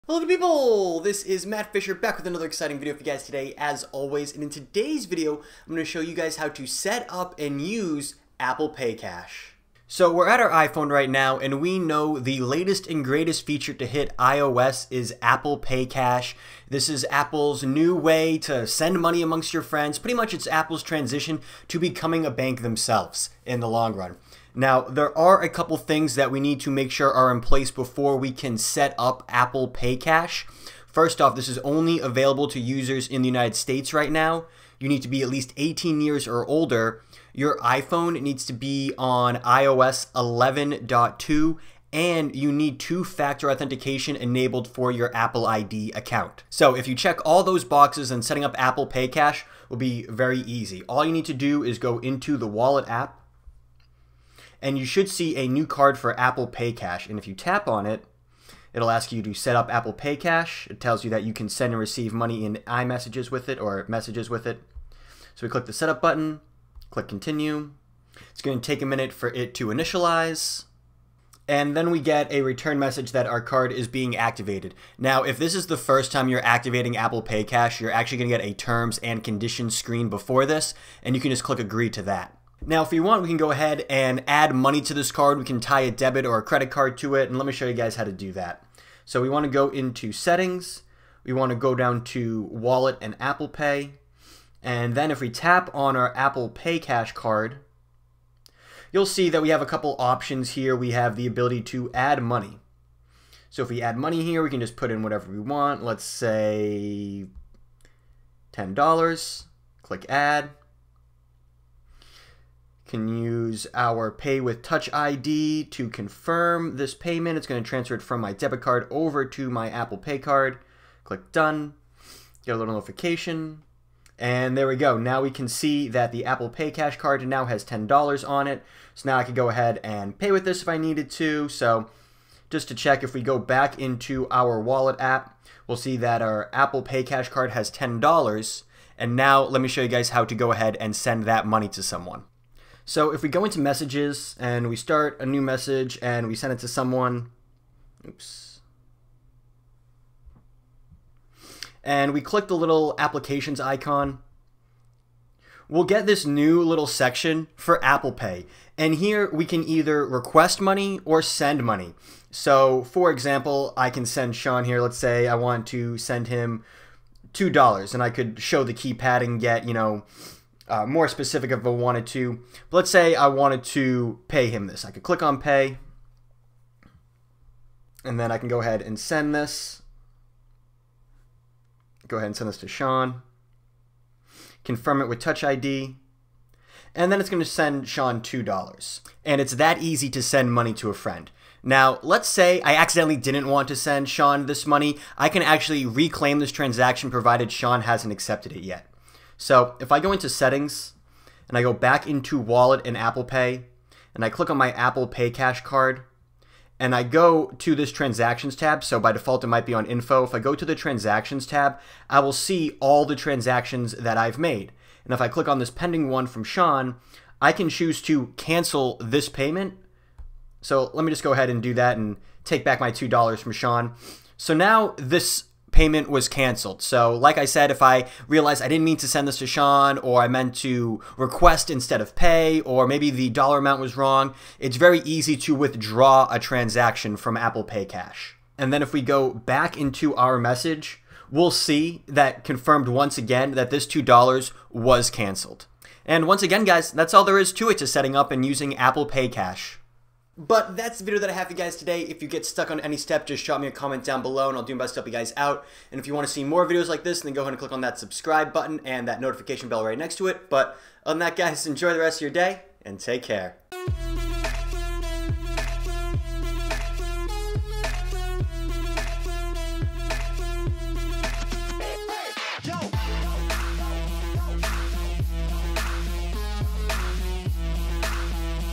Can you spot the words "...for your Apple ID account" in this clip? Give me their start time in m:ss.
0:44.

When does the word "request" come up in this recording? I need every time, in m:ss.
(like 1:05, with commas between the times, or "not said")
2:40, 3:51.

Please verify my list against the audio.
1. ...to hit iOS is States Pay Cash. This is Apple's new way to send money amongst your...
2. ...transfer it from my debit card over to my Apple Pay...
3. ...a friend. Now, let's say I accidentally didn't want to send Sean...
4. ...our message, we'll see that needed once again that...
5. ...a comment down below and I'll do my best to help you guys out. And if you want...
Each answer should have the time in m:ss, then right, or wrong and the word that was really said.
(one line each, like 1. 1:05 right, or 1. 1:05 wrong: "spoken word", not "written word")
1. 0:13 wrong: "Apple", not "States"
2. 1:57 right
3. 3:10 right
4. 4:00 wrong: "confirmed", not "needed"
5. 4:13 right.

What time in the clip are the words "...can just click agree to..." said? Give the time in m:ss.
1:21.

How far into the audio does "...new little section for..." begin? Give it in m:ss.
2:36.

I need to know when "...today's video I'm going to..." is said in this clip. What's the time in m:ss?
0:04.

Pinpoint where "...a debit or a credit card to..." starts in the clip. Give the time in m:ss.
1:25.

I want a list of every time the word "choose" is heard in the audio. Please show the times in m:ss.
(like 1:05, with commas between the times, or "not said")
3:37.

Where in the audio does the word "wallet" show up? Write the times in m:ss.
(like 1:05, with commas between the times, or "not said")
0:52, 1:32, 2:14, 3:22.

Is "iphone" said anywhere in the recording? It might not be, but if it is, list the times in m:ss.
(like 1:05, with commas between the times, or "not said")
0:10, 0:37.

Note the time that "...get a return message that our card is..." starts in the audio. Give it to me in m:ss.
1:11.